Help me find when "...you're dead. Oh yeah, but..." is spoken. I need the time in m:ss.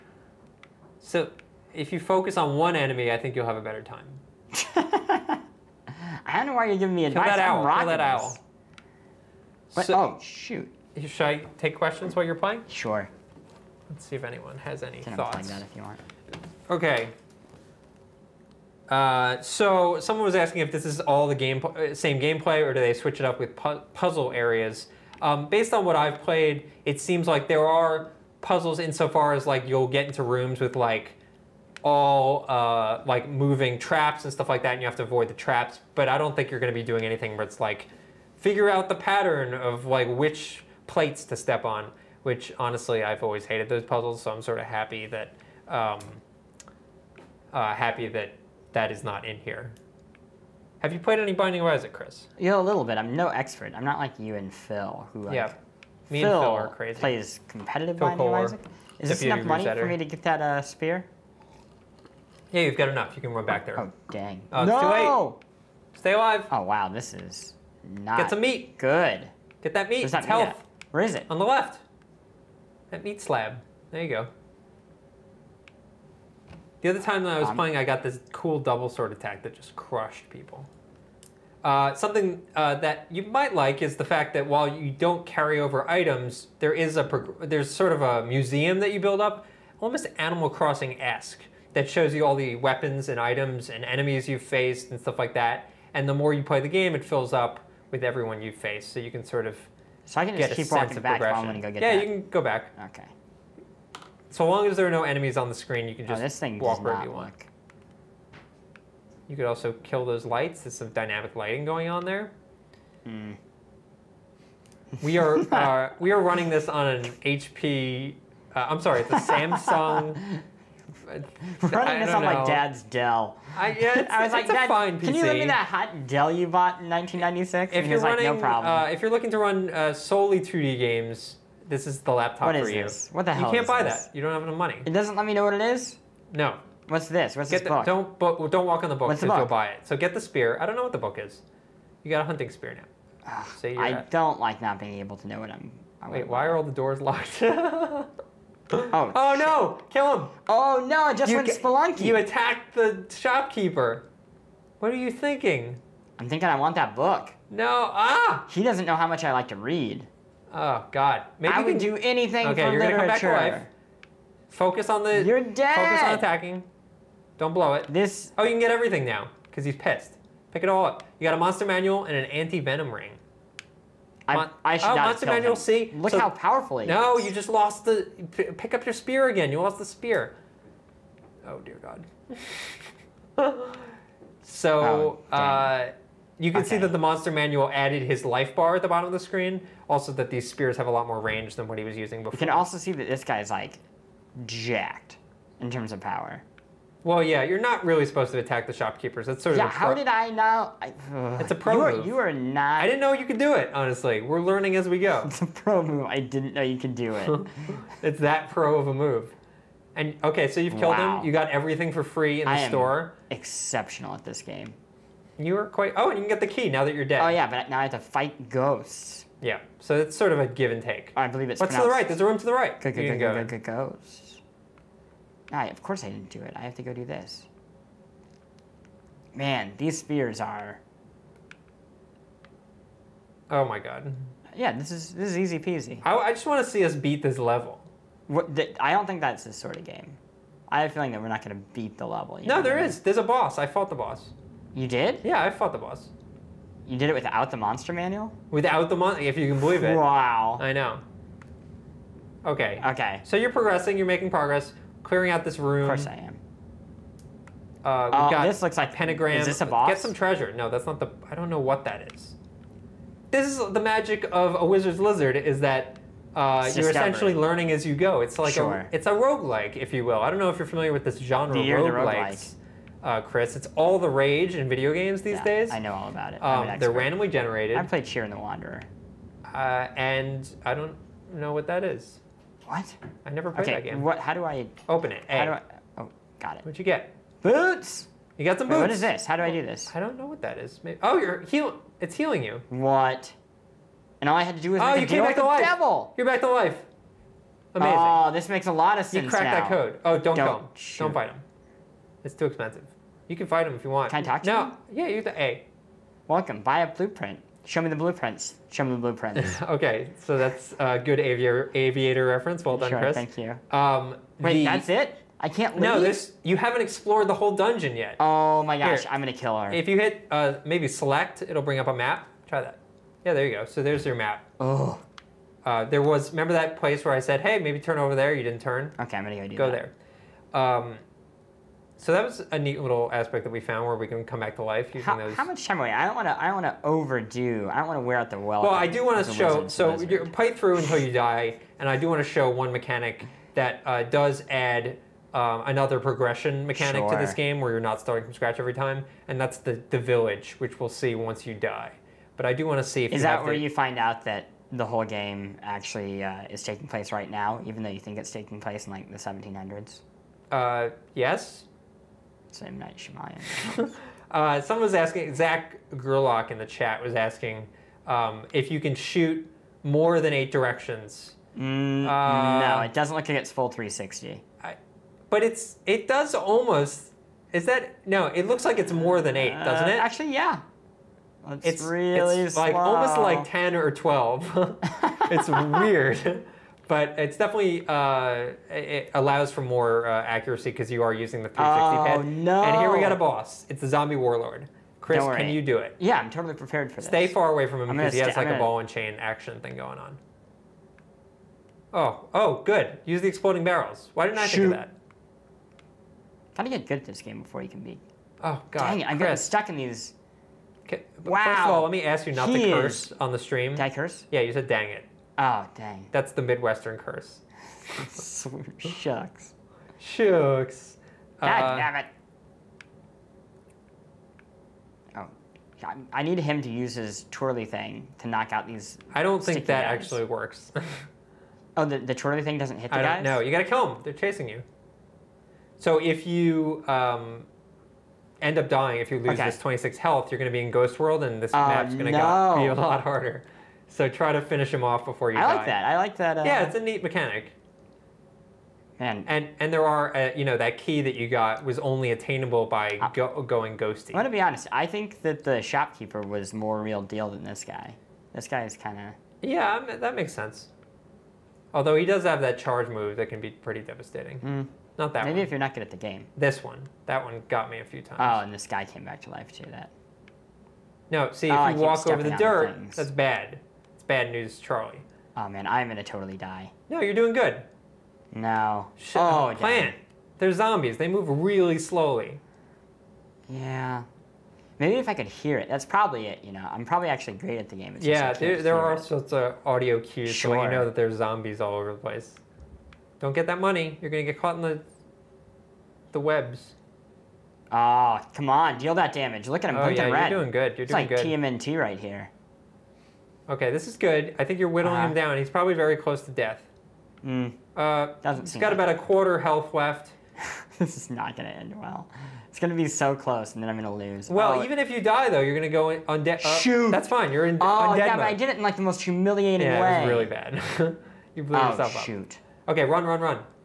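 3:36.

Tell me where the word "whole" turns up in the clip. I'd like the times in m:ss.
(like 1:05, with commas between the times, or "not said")
5:17, 5:54.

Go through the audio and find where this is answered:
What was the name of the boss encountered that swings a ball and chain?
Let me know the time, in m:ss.
6:33.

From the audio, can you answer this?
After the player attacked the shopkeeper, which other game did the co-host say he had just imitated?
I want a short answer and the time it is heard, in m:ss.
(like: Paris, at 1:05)
Spelunky, at 2:31.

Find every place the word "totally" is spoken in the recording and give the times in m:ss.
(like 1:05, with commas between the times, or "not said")
6:36, 7:56.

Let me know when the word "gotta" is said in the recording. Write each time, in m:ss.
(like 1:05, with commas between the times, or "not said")
6:46, 7:13.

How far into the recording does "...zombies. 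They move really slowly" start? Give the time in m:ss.
8:00.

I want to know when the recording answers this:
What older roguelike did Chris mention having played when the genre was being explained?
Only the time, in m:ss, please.
4:38.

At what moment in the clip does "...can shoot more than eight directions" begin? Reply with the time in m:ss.
6:08.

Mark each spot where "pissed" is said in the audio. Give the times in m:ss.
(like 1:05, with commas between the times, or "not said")
2:49.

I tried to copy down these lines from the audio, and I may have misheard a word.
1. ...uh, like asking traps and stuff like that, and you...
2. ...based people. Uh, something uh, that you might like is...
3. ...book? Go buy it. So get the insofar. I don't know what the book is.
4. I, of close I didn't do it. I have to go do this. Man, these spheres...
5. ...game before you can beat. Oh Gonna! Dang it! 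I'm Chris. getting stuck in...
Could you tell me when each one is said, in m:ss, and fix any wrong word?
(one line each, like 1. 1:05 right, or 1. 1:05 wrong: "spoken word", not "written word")
1. 0:32 wrong: "moving", not "asking"
2. 1:19 wrong: "crushed", not "based"
3. 2:19 wrong: "spear", not "insofar"
4. 3:45 wrong: "course", not "close"
5. 6:47 wrong: "God", not "Gonna".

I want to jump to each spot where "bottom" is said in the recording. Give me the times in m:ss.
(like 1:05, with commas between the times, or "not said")
3:08.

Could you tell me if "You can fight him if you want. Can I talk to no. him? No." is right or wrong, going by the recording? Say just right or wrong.
right.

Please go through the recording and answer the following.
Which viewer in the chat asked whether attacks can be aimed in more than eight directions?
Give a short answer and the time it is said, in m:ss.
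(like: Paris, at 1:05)
Zach Gerlach, at 6:05.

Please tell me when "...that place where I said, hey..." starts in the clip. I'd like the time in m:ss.
5:26.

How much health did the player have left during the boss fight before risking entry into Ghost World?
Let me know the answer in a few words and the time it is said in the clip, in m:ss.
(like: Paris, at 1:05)
26, at 7:19.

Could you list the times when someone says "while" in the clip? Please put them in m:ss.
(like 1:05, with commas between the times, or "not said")
0:12, 1:24, 1:41.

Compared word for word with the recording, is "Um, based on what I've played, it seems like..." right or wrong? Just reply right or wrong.
right.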